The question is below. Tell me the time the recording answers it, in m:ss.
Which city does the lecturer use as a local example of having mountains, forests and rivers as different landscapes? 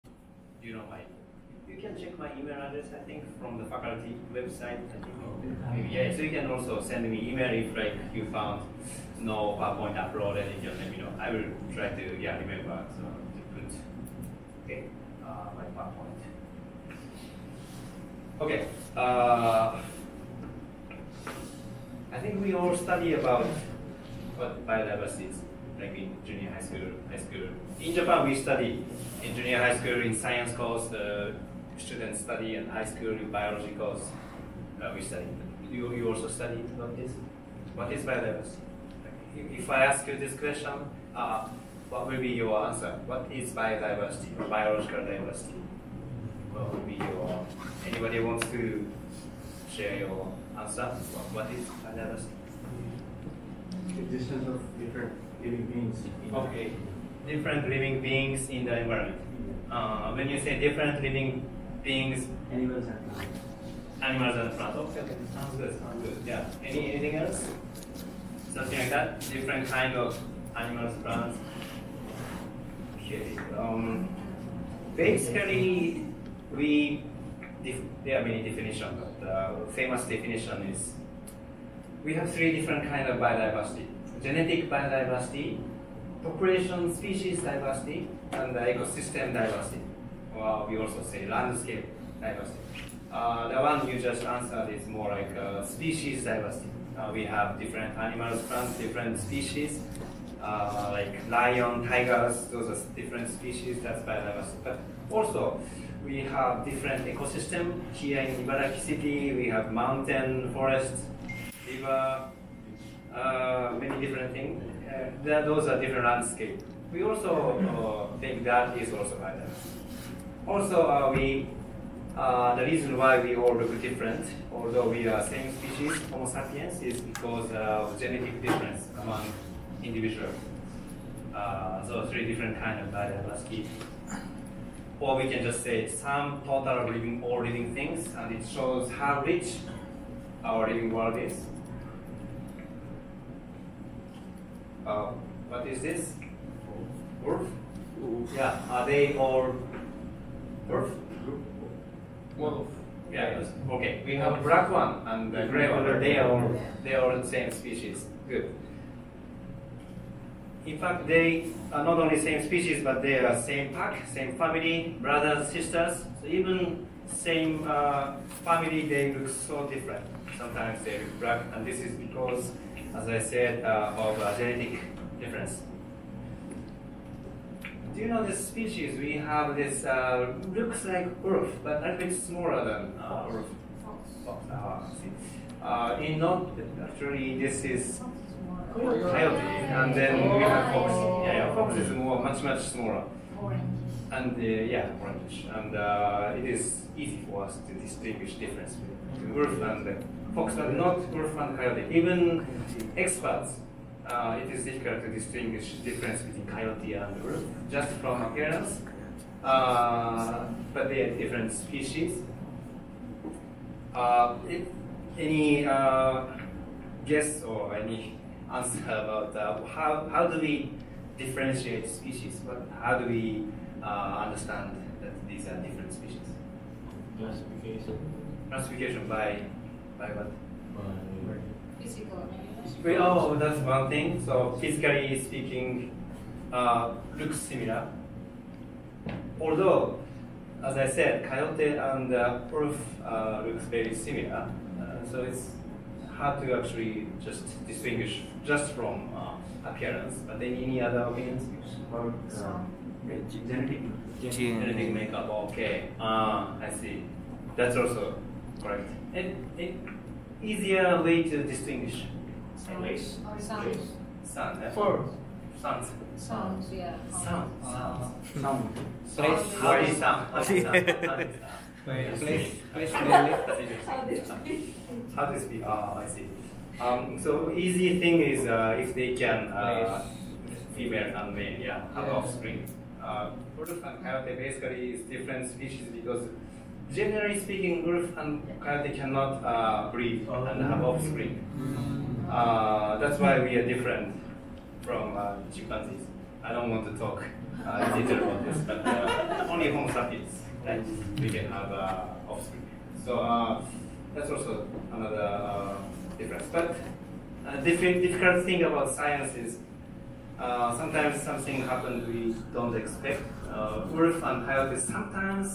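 1:48.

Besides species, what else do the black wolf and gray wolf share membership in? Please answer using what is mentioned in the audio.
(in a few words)
pack.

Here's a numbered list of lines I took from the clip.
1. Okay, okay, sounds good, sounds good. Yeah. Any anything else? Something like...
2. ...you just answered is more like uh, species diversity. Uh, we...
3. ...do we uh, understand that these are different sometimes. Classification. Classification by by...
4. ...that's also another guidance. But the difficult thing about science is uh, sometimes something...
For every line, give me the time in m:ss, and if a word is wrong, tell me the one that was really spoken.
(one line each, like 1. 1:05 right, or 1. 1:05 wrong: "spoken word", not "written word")
1. 1:04 right
2. 1:33 right
3. 3:42 wrong: "species", not "sometimes"
4. 5:04 wrong: "difference", not "guidance".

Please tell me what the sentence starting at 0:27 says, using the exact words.
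In Japan, we study in junior high school in science course.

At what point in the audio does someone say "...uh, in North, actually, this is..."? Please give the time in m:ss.
3:05.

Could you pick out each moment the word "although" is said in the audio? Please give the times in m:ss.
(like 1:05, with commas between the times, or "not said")
2:04, 3:59.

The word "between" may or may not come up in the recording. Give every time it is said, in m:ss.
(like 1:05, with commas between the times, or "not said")
3:18, 3:26.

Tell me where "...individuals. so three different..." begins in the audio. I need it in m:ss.
2:09.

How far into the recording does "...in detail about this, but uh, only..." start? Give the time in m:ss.
4:57.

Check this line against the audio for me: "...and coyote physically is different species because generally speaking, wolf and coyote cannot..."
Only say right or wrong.
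wrong.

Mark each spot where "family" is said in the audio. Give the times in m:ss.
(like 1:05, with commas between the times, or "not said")
2:44, 2:48.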